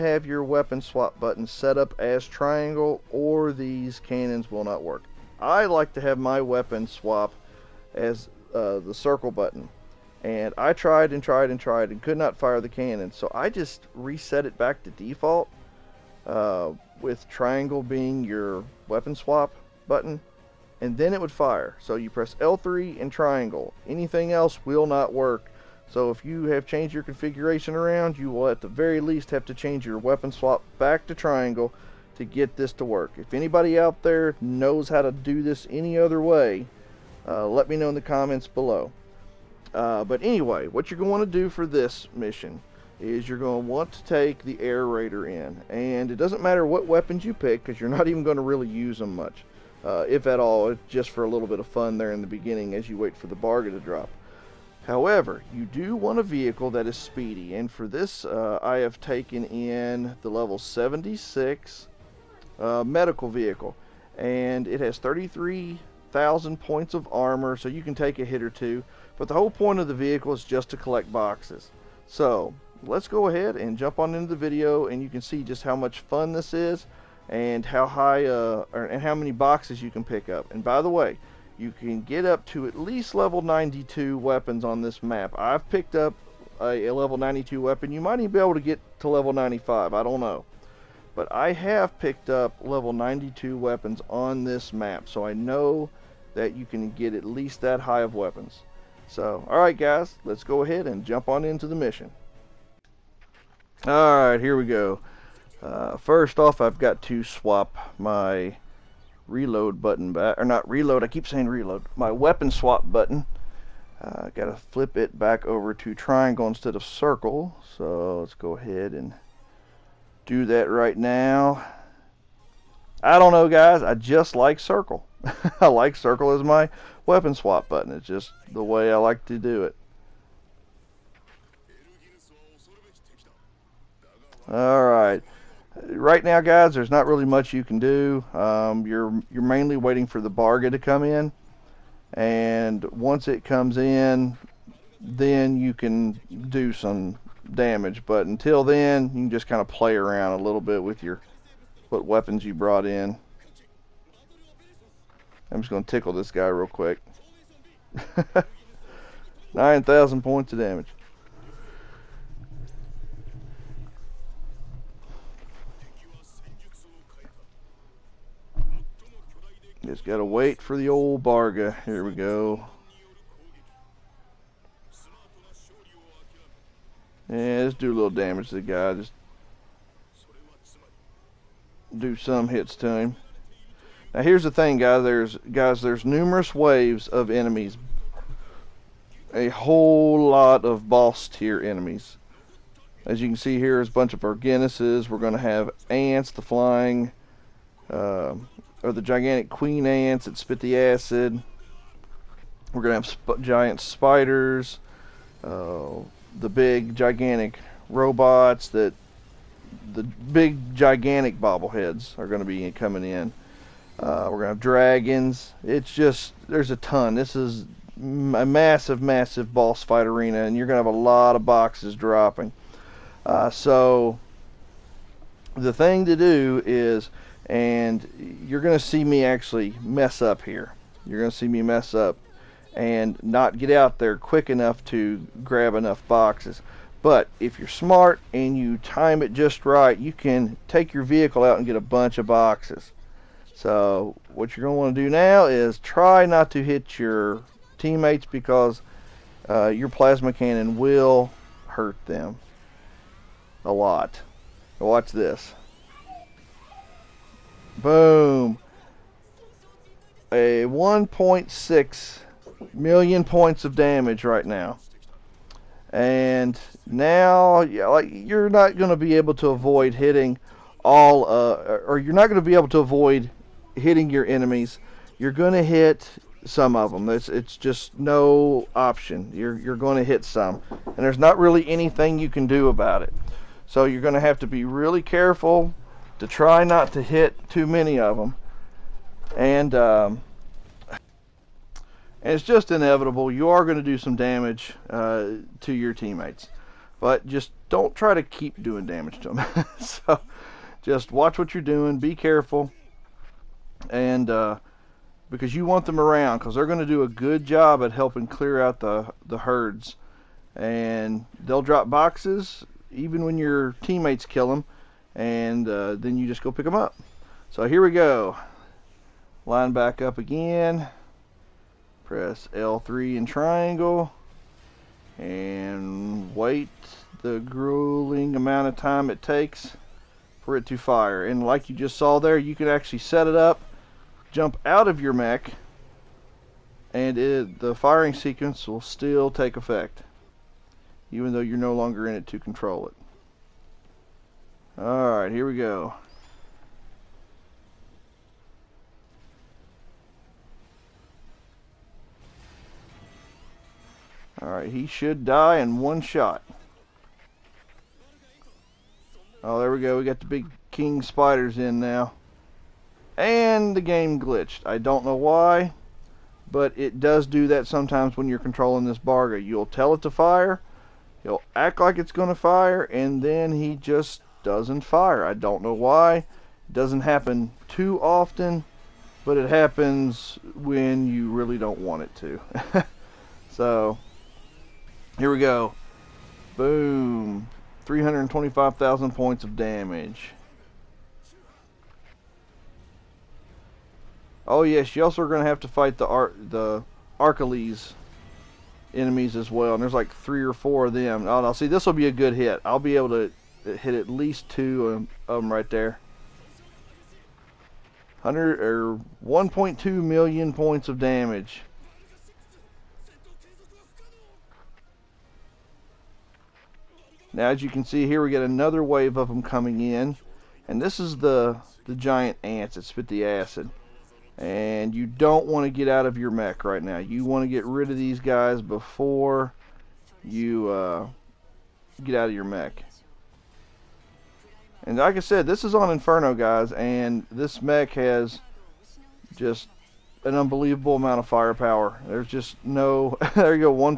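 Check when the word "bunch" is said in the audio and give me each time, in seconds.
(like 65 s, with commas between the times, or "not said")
193 s, 241 s.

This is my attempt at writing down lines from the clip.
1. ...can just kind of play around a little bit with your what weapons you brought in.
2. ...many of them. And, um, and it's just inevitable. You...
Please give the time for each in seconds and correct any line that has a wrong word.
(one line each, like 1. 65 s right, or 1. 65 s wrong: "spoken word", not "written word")
1. 149 s right
2. 287 s right.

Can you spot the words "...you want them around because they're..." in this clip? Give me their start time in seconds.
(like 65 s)
305 s.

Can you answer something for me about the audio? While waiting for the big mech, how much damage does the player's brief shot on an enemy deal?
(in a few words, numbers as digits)
9,000.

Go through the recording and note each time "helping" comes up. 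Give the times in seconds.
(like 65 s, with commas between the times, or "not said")
307 s.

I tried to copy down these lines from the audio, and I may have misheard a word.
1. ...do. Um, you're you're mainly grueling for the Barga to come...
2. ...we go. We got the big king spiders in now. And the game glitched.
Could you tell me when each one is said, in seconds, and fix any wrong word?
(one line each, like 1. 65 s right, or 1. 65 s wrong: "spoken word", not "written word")
1. 137 s wrong: "waiting", not "grueling"
2. 359 s right.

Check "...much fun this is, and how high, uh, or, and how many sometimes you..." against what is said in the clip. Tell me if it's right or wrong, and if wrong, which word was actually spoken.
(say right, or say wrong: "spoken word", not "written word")
wrong: "boxes", not "sometimes".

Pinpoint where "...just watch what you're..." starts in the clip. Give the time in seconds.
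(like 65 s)
300 s.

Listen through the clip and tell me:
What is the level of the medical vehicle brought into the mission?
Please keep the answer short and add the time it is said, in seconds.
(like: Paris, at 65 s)
76, at 60 s.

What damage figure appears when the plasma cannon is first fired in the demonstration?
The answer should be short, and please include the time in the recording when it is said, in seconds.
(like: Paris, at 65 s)
1.6 million, at 260 s.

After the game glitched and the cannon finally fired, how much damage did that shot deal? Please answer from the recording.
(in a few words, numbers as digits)
325,000.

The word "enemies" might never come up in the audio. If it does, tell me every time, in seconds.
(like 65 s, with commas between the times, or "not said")
187 s, 191 s, 274 s, 398 s.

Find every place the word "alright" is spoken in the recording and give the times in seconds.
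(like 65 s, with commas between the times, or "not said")
99 s, 103 s, 344 s, 354 s.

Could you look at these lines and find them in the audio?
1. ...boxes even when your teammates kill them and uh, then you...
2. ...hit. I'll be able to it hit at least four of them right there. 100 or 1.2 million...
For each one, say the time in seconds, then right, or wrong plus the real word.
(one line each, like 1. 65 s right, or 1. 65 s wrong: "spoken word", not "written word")
1. 311 s right
2. 402 s wrong: "two", not "four".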